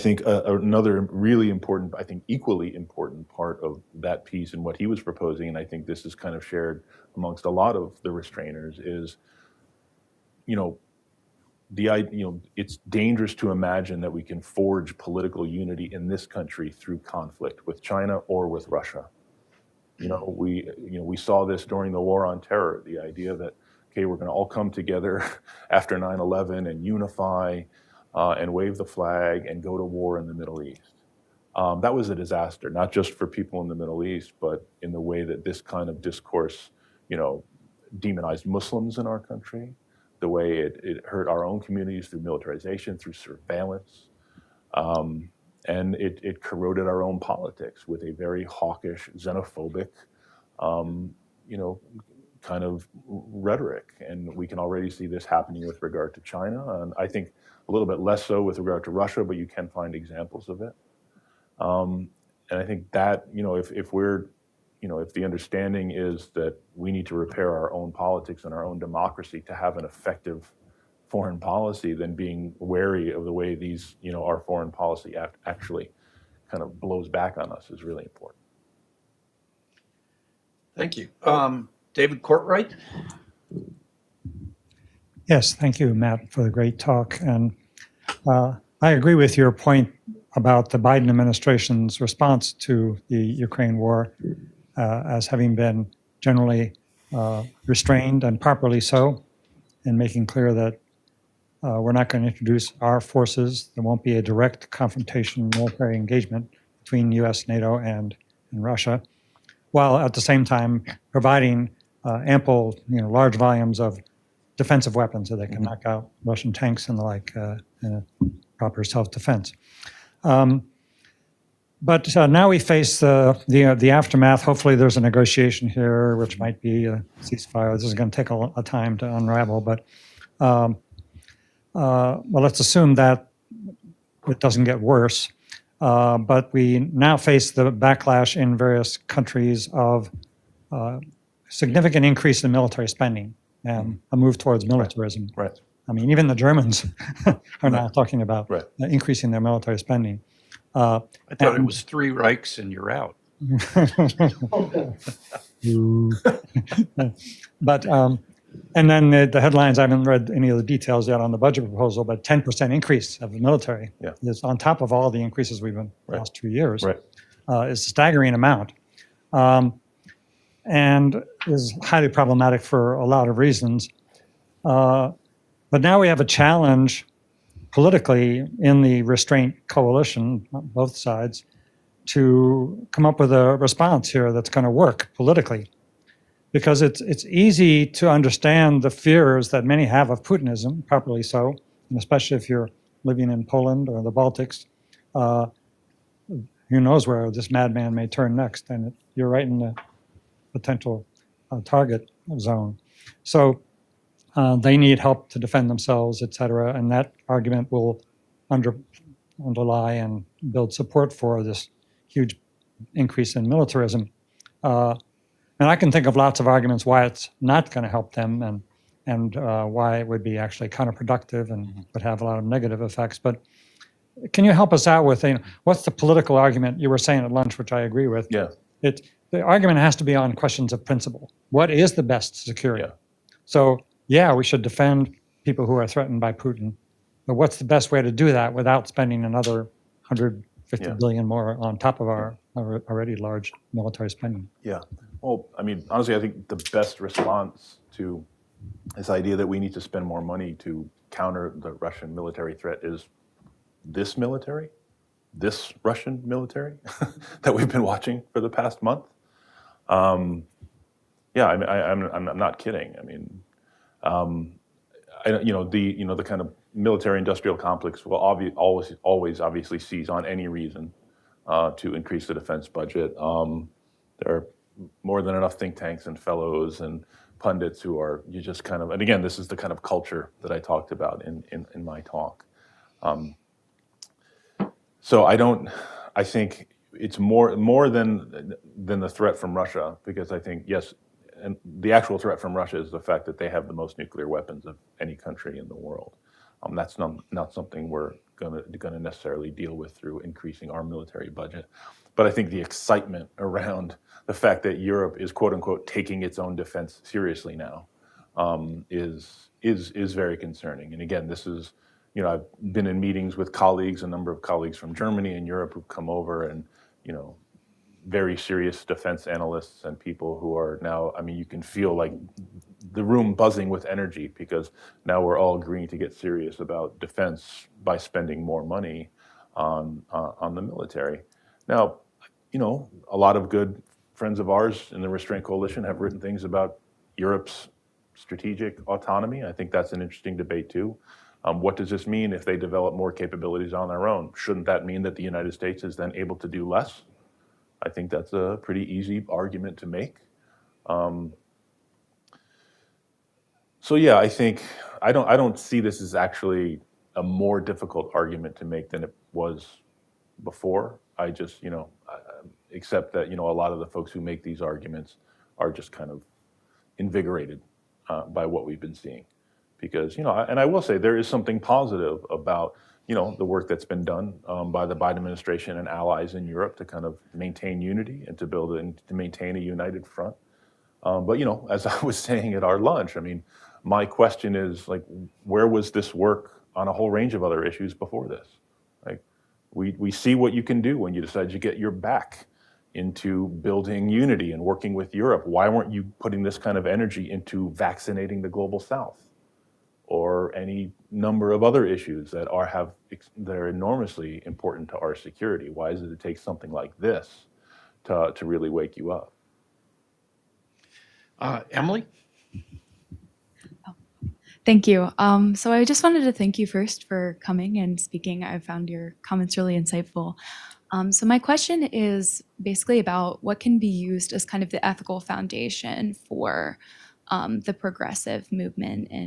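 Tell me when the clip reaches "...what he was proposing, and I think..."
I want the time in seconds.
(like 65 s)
4 s.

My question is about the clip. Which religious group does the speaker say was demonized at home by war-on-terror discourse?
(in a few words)
Muslims.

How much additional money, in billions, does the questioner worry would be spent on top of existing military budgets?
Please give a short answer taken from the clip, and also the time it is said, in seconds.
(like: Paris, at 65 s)
150 billion, at 240 s.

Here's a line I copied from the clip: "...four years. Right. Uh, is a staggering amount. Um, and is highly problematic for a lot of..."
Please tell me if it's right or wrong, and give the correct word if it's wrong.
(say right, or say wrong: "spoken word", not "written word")
wrong: "two", not "four".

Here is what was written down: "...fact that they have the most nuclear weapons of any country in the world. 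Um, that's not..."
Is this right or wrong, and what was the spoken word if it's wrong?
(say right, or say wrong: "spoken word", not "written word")
right.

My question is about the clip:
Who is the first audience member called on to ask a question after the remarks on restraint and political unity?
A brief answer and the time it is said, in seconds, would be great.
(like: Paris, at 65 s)
David Cortright, at 81 s.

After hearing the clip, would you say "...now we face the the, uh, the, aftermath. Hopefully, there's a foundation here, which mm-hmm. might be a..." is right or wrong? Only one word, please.
wrong.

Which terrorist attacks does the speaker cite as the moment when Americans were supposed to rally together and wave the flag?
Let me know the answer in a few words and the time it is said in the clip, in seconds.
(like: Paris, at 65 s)
9/11, at 25 s.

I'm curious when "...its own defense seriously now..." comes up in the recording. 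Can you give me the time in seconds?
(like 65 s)
306 s.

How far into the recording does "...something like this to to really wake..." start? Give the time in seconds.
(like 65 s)
406 s.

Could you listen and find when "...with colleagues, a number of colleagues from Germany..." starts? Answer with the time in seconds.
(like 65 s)
313 s.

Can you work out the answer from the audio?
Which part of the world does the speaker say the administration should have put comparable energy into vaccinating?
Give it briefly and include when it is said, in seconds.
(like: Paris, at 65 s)
the global South, at 398 s.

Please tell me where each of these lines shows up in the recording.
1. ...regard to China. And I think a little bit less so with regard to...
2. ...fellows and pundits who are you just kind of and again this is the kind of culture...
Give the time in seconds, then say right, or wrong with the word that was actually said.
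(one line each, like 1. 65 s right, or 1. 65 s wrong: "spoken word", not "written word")
1. 55 s right
2. 276 s right.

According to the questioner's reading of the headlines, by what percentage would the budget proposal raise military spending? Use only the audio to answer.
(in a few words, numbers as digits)
10%.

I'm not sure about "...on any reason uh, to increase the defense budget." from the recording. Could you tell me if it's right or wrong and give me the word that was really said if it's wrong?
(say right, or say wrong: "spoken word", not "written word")
right.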